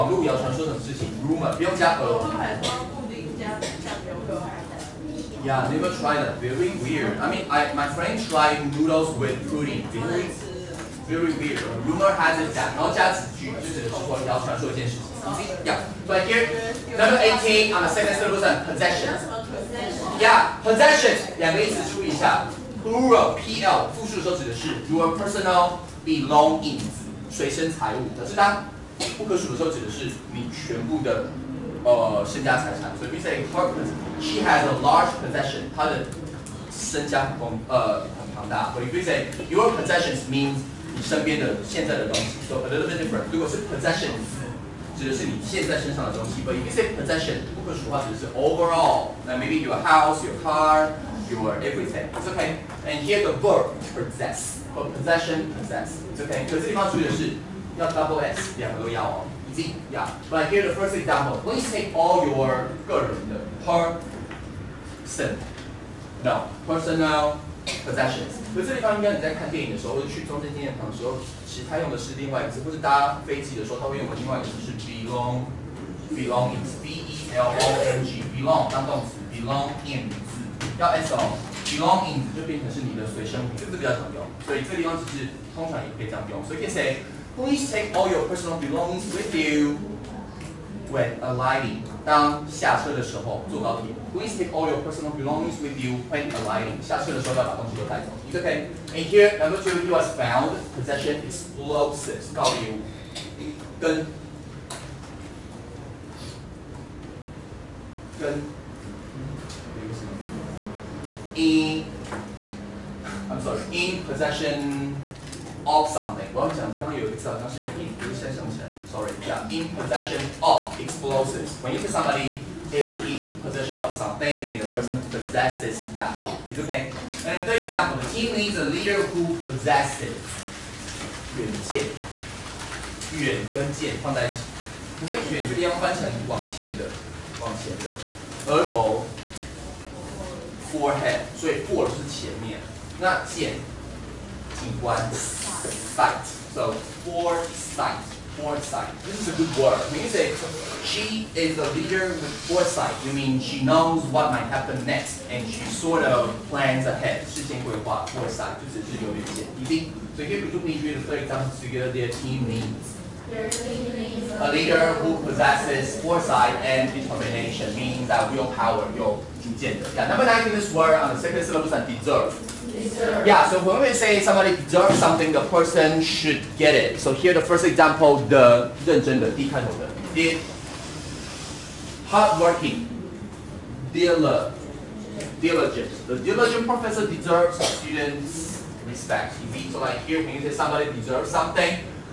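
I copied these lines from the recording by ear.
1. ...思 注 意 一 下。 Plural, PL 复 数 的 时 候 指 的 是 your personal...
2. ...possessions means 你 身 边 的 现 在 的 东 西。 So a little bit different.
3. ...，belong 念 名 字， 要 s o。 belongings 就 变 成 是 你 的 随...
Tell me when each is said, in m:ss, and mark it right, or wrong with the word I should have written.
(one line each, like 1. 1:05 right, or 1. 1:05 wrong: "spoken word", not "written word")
1. 0:21 right
2. 0:39 right
3. 1:19 right.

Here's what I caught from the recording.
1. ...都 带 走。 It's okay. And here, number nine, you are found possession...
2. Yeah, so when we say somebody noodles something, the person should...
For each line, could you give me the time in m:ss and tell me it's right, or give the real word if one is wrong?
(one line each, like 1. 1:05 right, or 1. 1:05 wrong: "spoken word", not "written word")
1. 1:37 wrong: "two", not "nine"
2. 2:53 wrong: "deserves", not "noodles".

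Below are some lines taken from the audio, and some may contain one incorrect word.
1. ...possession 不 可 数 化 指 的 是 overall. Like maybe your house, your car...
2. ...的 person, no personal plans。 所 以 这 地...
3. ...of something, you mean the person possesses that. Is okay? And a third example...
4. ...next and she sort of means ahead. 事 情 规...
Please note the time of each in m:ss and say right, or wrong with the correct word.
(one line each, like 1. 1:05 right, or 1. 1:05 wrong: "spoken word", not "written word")
1. 0:46 right
2. 1:03 wrong: "possessions", not "plans"
3. 2:03 right
4. 2:34 wrong: "plans", not "means".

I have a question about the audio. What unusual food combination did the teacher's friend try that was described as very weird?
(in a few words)
noodles with pudding.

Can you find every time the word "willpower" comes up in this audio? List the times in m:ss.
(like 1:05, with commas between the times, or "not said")
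2:48.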